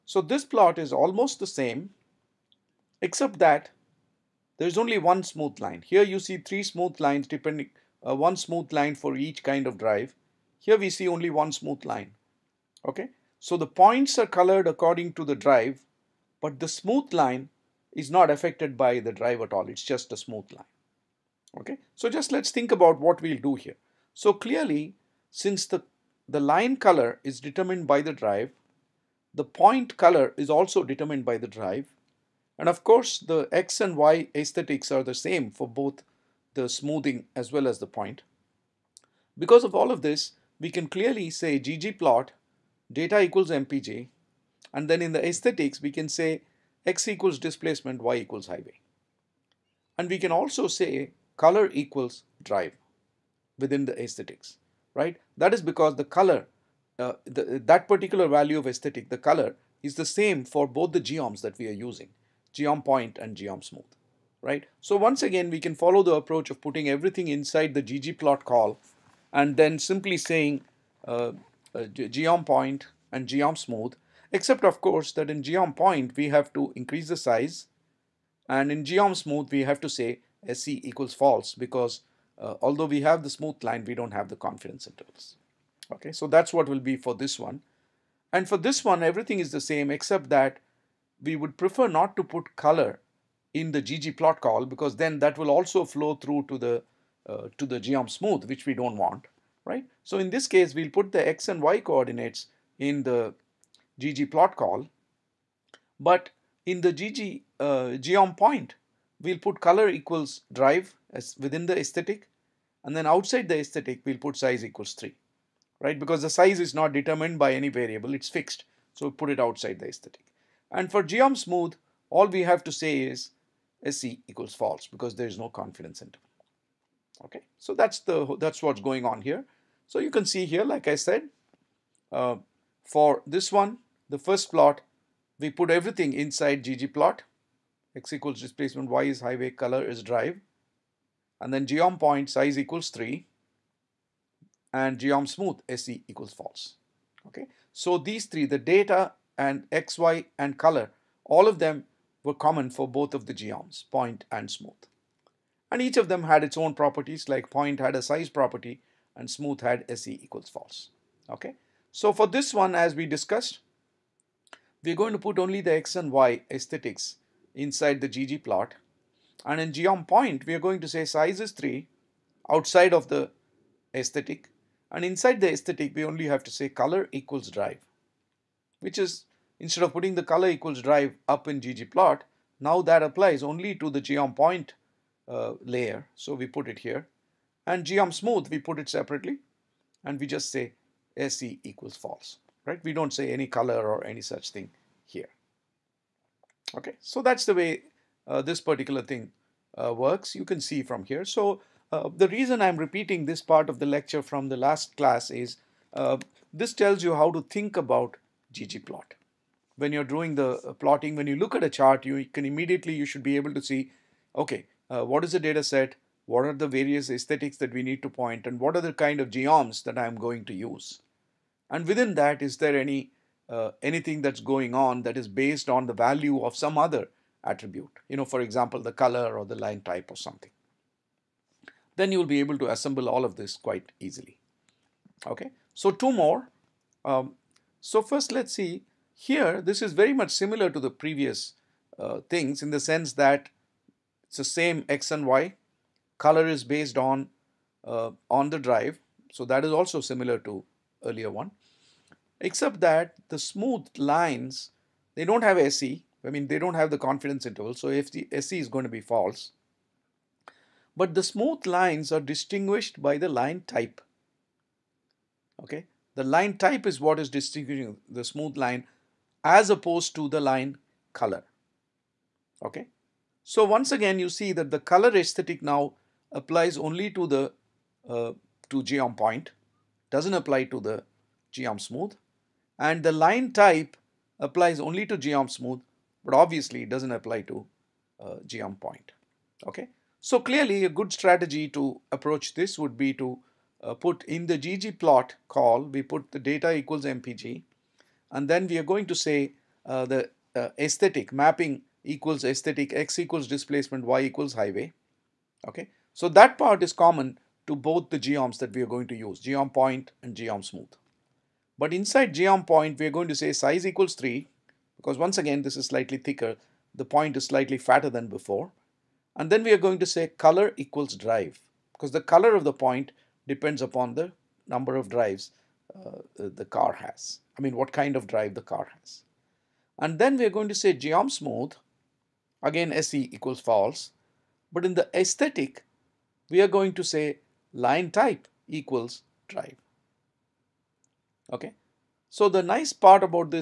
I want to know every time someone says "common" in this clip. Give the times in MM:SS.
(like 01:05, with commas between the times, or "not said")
02:32, 05:06.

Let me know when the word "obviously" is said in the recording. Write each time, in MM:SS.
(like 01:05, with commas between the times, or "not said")
04:46.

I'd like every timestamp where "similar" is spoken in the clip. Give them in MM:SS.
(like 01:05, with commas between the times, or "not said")
04:00, 04:10.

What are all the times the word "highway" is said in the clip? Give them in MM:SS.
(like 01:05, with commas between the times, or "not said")
00:48, 02:19, 05:04.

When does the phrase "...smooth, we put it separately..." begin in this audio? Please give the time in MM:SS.
03:08.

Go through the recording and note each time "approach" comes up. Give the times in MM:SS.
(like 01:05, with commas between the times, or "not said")
01:06, 04:52.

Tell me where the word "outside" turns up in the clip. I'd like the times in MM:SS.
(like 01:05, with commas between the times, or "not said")
01:53, 01:59, 02:52.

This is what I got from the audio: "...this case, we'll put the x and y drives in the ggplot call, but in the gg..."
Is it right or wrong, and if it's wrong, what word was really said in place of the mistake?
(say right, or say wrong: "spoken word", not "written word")
wrong: "coordinates", not "drives".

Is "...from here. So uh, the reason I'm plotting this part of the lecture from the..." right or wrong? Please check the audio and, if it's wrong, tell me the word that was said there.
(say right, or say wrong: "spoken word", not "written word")
wrong: "repeating", not "plotting".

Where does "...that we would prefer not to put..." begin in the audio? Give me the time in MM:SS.
01:30.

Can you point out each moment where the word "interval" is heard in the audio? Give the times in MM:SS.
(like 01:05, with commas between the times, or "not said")
01:24, 02:06, 04:17.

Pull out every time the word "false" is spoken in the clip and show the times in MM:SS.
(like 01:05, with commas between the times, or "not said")
01:21, 02:04, 02:26, 02:40, 03:11, 04:19, 05:33.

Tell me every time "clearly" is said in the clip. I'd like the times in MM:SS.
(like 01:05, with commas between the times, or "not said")
00:24, 00:40, 04:50.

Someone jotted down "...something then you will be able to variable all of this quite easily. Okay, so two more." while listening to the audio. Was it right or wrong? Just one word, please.
wrong.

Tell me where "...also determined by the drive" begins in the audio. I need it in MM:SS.
00:30.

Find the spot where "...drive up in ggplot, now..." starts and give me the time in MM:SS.
03:00.